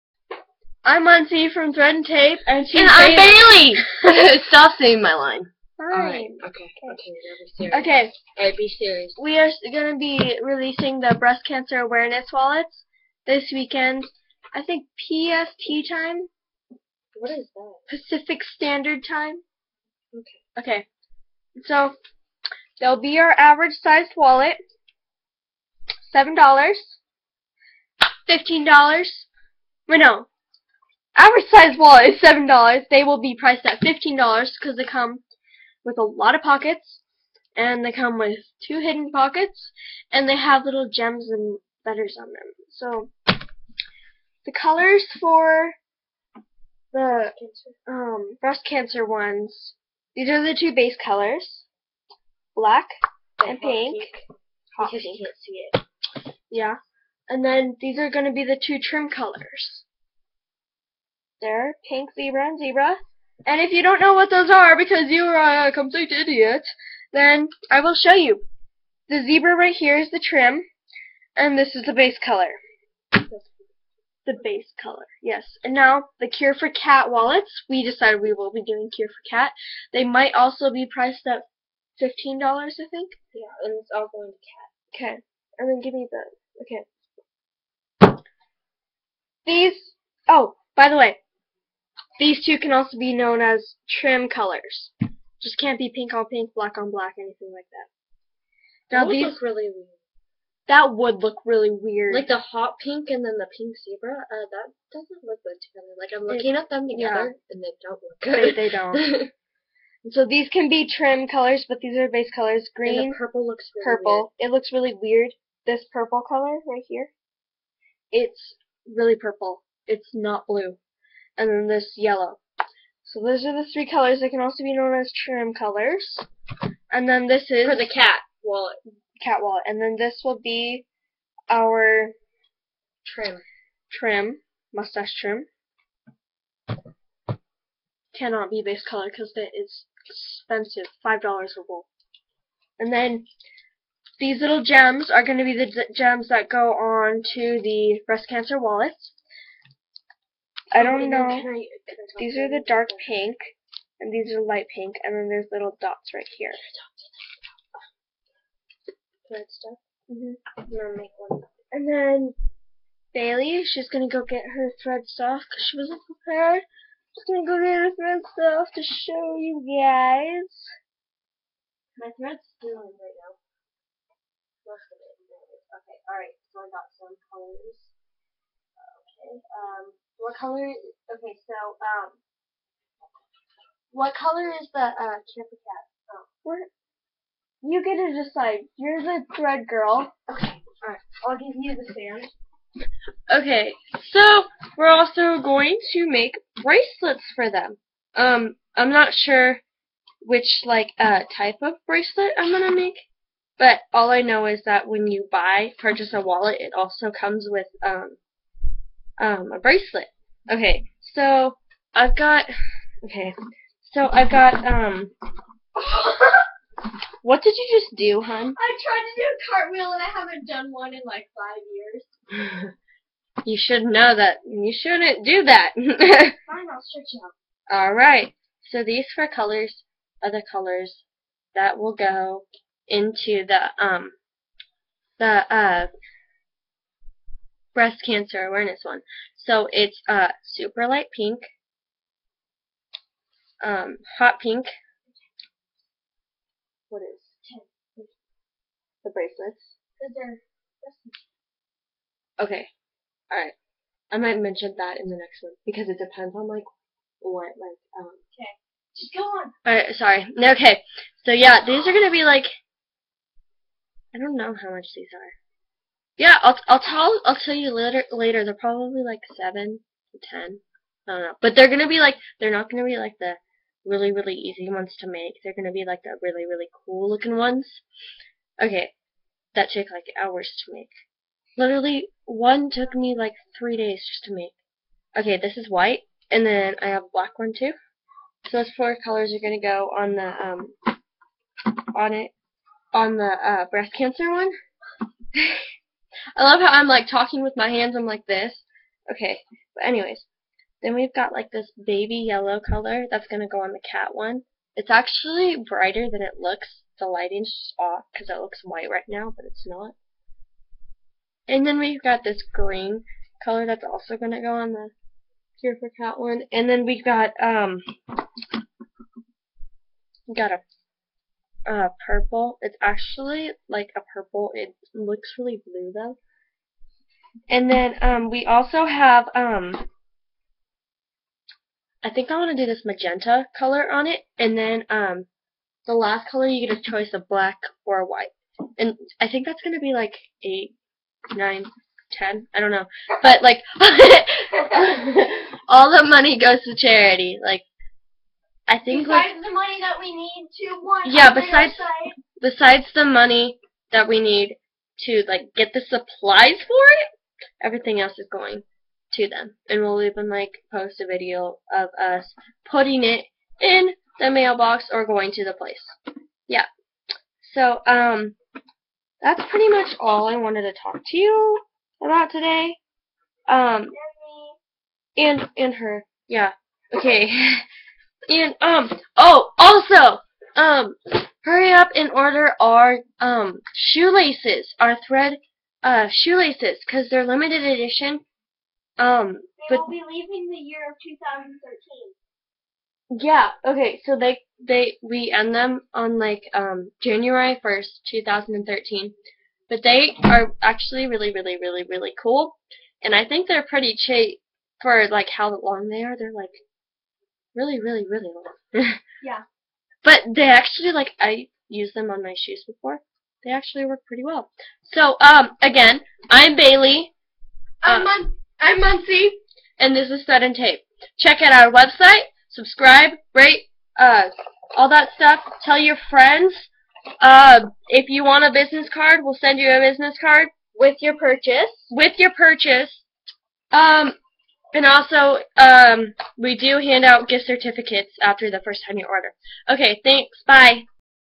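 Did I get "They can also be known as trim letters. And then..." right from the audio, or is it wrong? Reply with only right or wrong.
wrong.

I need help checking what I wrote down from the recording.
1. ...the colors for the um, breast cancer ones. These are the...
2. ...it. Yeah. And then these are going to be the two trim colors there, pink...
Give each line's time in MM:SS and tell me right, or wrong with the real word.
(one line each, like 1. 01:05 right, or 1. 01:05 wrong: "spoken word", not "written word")
1. 00:44 right
2. 00:56 right.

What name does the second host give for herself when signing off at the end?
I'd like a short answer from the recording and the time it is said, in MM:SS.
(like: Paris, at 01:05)
Muntzie, at 06:58.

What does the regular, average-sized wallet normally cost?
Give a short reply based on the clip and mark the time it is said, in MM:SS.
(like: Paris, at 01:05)
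$7, at 00:31.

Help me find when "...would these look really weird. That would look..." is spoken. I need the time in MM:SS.
01:39.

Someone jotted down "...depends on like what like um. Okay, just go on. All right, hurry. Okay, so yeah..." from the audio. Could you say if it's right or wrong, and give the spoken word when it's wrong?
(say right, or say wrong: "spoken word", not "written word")
wrong: "sorry", not "hurry".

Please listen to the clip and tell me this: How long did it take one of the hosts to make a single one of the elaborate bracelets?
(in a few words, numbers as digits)
3 days.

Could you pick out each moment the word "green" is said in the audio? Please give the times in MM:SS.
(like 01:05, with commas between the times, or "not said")
01:52, 05:12.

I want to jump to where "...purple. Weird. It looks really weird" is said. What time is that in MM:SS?
01:53.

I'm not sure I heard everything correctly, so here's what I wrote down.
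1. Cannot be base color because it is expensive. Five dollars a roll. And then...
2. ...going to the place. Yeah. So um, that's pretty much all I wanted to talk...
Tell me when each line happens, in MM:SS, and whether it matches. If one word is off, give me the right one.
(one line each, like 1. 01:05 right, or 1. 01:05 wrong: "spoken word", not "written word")
1. 02:18 right
2. 06:05 right.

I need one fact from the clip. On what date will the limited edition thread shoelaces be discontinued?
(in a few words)
January 1st, 2013.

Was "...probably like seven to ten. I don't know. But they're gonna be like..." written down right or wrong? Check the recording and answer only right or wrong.
right.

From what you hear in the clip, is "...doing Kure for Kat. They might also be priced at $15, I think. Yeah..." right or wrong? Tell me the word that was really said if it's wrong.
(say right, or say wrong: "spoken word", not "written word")
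right.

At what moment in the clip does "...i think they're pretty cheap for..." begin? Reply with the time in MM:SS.
06:43.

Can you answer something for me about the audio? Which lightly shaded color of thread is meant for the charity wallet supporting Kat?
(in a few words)
baby yellow.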